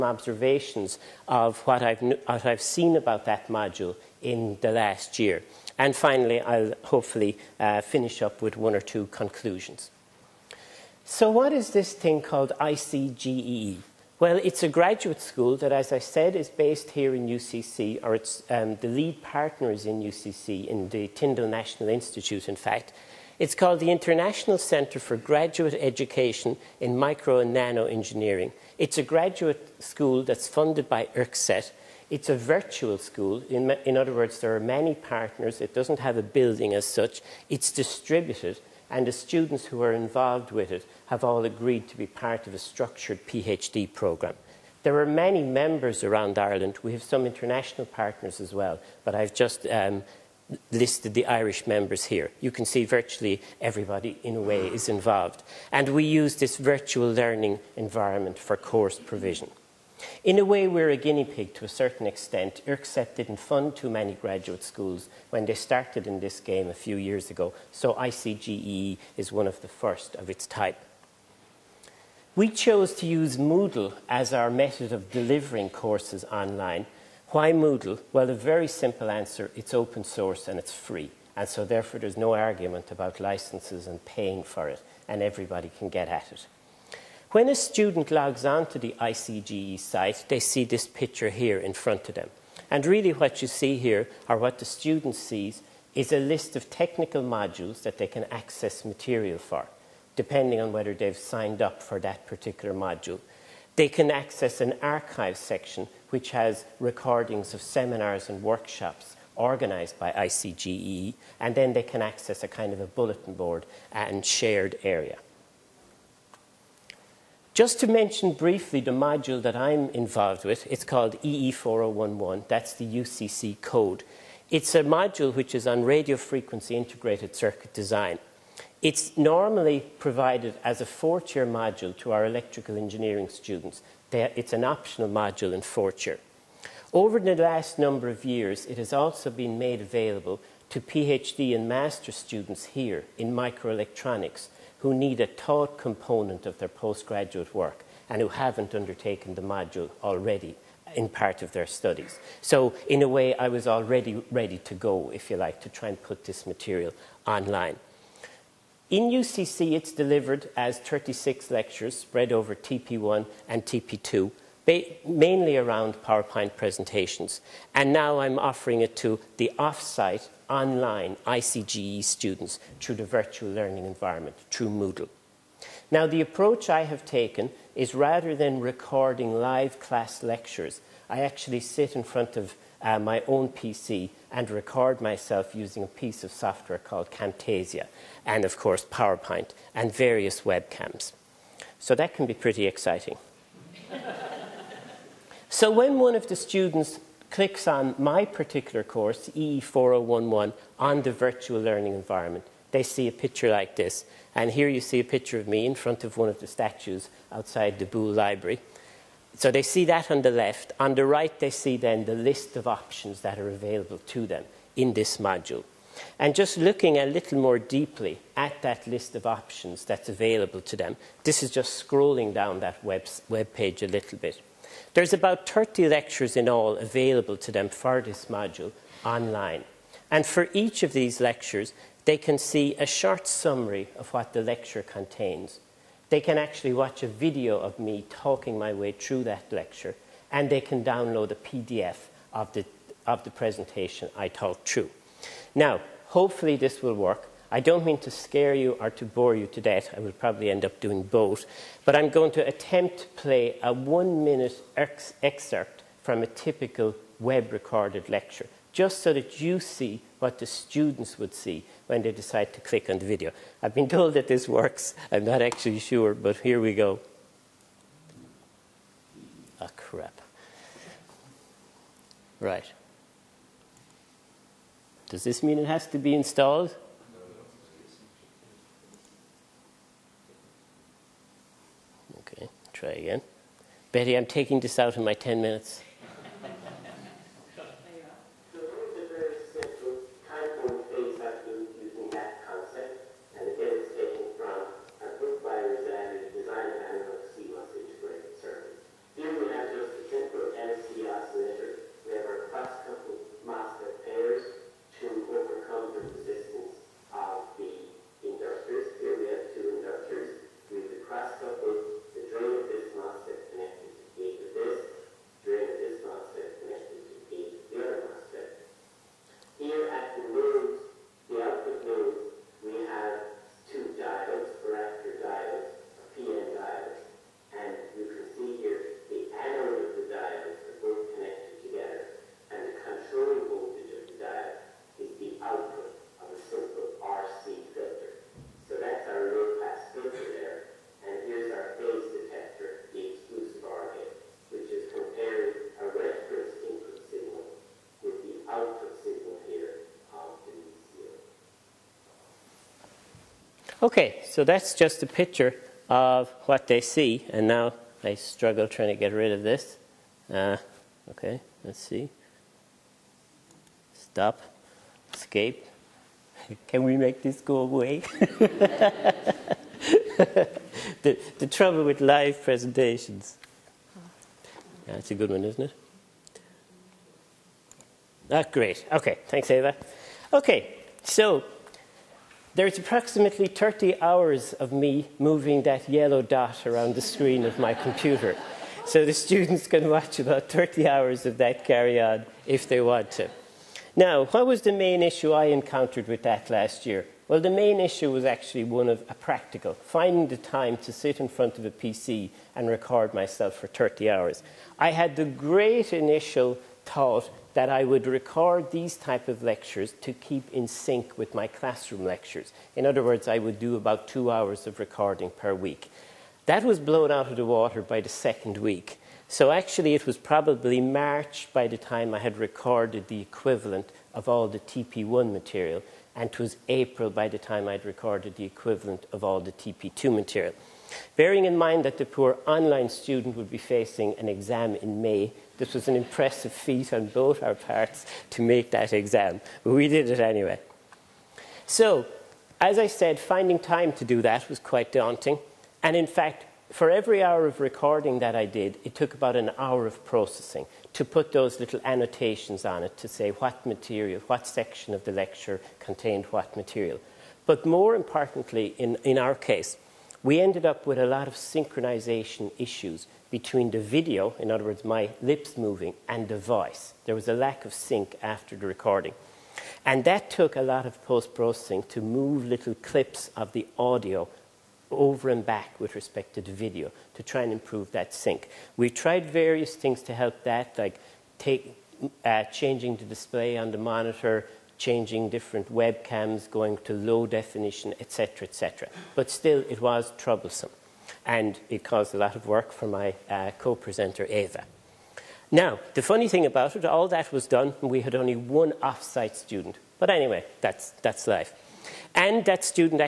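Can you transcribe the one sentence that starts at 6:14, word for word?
That's a good one, isn't it?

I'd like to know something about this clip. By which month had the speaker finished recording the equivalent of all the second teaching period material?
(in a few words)
April.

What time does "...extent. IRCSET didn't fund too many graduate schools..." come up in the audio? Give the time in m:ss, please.
1:02.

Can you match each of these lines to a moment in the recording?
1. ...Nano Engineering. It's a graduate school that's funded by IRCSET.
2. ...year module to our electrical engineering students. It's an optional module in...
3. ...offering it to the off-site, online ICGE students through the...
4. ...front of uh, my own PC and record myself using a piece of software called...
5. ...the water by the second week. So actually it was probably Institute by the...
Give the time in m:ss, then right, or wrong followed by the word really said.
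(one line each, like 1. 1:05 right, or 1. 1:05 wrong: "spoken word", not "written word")
1. 0:27 right
2. 2:11 right
3. 2:48 right
4. 3:02 right
5. 6:57 wrong: "March", not "Institute".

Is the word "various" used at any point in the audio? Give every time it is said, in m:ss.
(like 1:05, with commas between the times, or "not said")
3:09, 7:59.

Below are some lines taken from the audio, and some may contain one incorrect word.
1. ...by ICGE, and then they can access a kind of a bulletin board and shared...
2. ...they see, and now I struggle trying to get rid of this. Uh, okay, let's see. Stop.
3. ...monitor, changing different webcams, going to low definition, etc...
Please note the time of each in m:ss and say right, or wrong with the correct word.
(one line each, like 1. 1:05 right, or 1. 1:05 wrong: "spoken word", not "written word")
1. 1:49 right
2. 5:56 right
3. 8:03 right.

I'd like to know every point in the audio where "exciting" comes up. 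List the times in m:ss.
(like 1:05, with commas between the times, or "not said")
3:12.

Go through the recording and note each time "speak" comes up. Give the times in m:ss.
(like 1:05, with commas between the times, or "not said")
not said.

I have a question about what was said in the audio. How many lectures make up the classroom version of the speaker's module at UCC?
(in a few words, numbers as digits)
36.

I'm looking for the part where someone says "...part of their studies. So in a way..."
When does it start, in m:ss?
2:31.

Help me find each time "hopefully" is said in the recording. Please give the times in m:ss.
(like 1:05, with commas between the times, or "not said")
0:06, 4:06.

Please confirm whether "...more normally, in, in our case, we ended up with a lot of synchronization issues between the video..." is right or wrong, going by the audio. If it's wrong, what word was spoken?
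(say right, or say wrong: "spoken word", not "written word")
wrong: "importantly", not "normally".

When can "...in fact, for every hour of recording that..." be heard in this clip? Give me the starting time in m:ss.
7:25.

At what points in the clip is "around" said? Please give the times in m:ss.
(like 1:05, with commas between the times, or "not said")
0:46, 2:45, 6:26.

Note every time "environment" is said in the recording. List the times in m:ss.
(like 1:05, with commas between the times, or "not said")
0:57, 2:53, 3:21.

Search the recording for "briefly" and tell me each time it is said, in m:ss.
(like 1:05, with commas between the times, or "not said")
1:58.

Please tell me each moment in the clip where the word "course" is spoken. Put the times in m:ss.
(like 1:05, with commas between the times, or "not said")
0:58, 1:15, 3:08, 3:18.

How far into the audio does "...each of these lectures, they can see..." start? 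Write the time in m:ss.
3:50.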